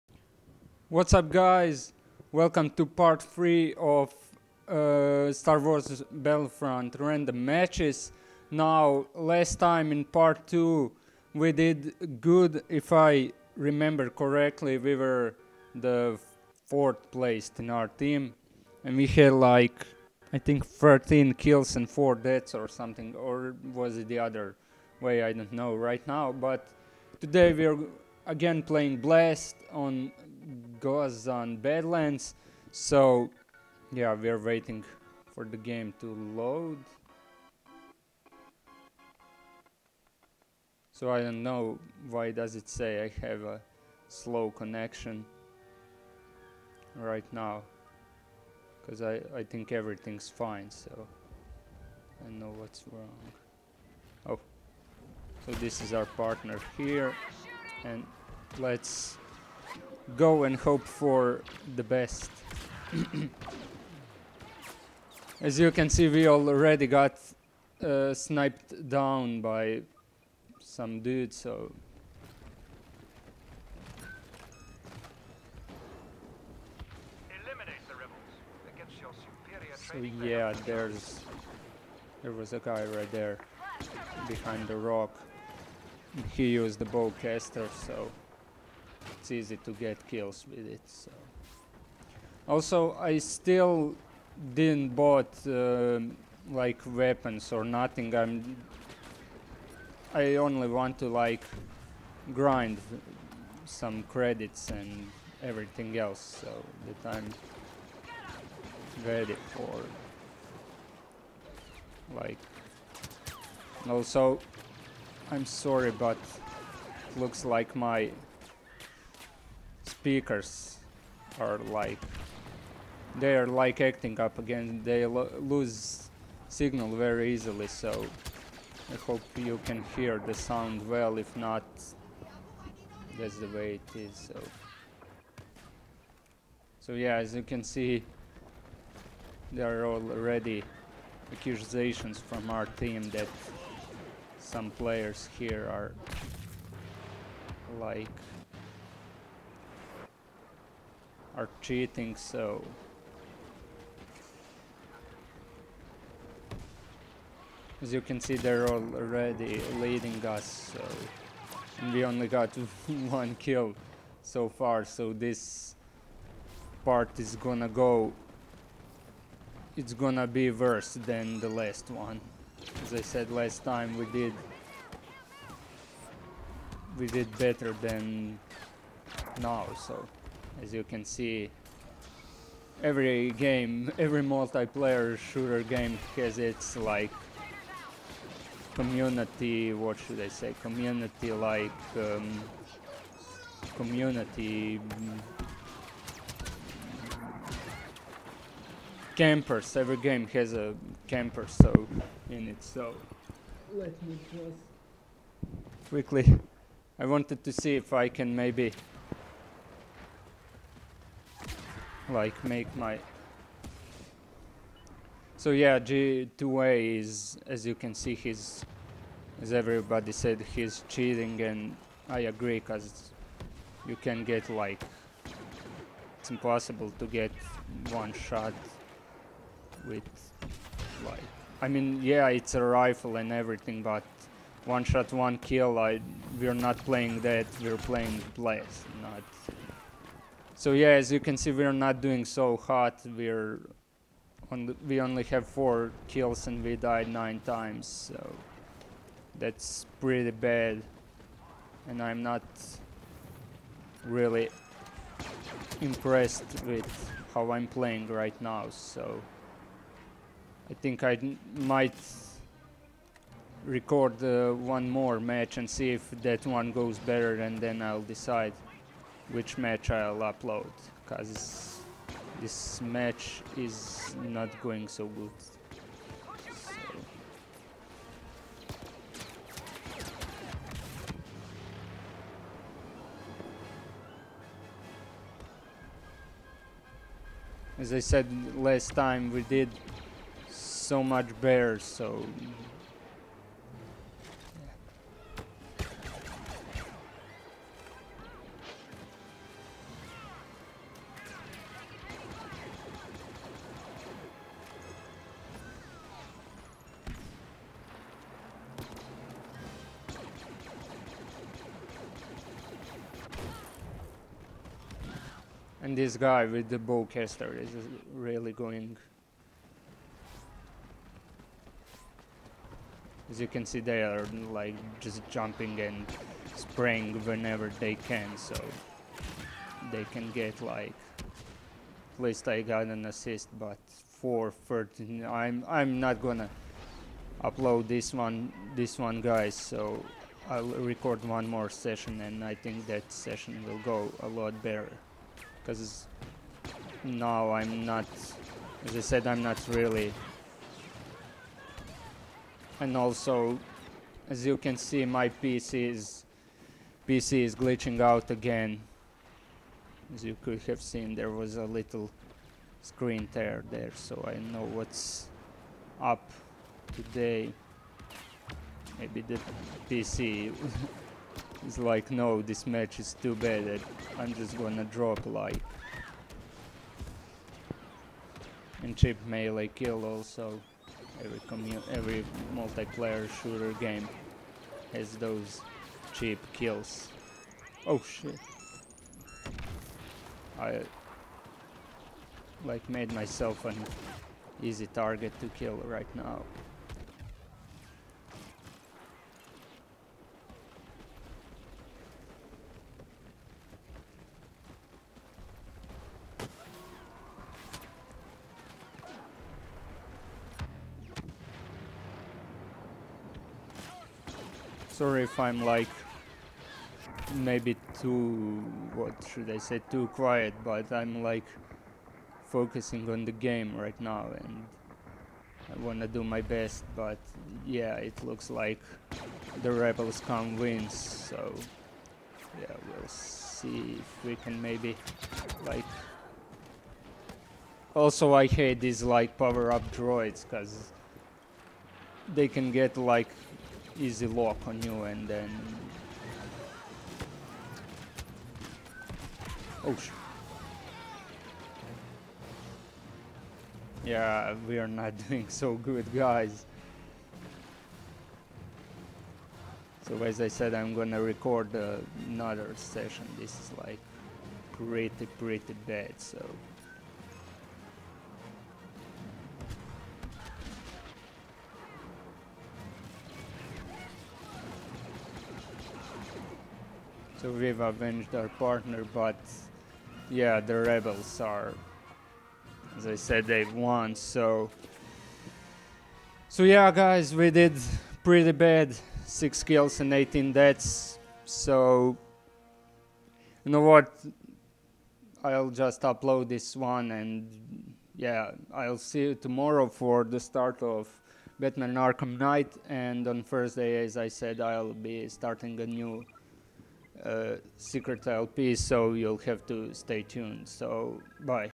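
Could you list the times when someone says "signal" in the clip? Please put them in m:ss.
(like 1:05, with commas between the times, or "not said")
2:06.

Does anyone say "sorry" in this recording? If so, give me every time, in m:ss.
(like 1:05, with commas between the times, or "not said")
1:55, 6:54.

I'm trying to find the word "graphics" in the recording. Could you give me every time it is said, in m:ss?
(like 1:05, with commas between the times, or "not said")
not said.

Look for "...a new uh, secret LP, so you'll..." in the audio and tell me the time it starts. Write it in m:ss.
8:25.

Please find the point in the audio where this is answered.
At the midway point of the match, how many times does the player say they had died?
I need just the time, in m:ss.
4:07.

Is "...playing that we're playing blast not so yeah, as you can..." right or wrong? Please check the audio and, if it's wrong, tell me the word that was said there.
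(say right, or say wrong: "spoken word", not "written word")
right.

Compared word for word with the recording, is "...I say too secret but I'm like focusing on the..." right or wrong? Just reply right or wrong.
wrong.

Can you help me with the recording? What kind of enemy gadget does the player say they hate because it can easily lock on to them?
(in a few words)
Power up droids.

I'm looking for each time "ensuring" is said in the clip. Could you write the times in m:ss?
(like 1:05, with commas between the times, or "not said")
not said.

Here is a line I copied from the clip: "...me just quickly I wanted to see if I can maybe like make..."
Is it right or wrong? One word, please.
right.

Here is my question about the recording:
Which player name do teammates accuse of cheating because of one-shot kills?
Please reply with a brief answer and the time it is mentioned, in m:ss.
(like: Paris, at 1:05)
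G2A, at 3:35.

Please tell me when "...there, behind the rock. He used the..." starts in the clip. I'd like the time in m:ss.
1:23.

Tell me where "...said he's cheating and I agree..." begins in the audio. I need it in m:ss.
3:40.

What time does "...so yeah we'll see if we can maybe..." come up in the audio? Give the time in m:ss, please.
7:10.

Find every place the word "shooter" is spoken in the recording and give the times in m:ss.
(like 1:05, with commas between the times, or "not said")
3:05, 6:23.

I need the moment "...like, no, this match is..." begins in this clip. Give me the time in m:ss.
6:11.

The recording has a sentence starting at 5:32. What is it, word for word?
At least I got an assist, but 413.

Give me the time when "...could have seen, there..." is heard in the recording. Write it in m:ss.
6:00.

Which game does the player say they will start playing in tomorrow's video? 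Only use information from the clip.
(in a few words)
Batman Arkham Knight.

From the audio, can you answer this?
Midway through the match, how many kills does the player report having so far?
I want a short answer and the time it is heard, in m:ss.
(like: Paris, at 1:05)
4, at 4:05.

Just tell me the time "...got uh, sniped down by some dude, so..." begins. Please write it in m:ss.
1:06.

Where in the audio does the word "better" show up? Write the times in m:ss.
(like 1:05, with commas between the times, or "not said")
2:57, 4:26, 4:51, 5:44.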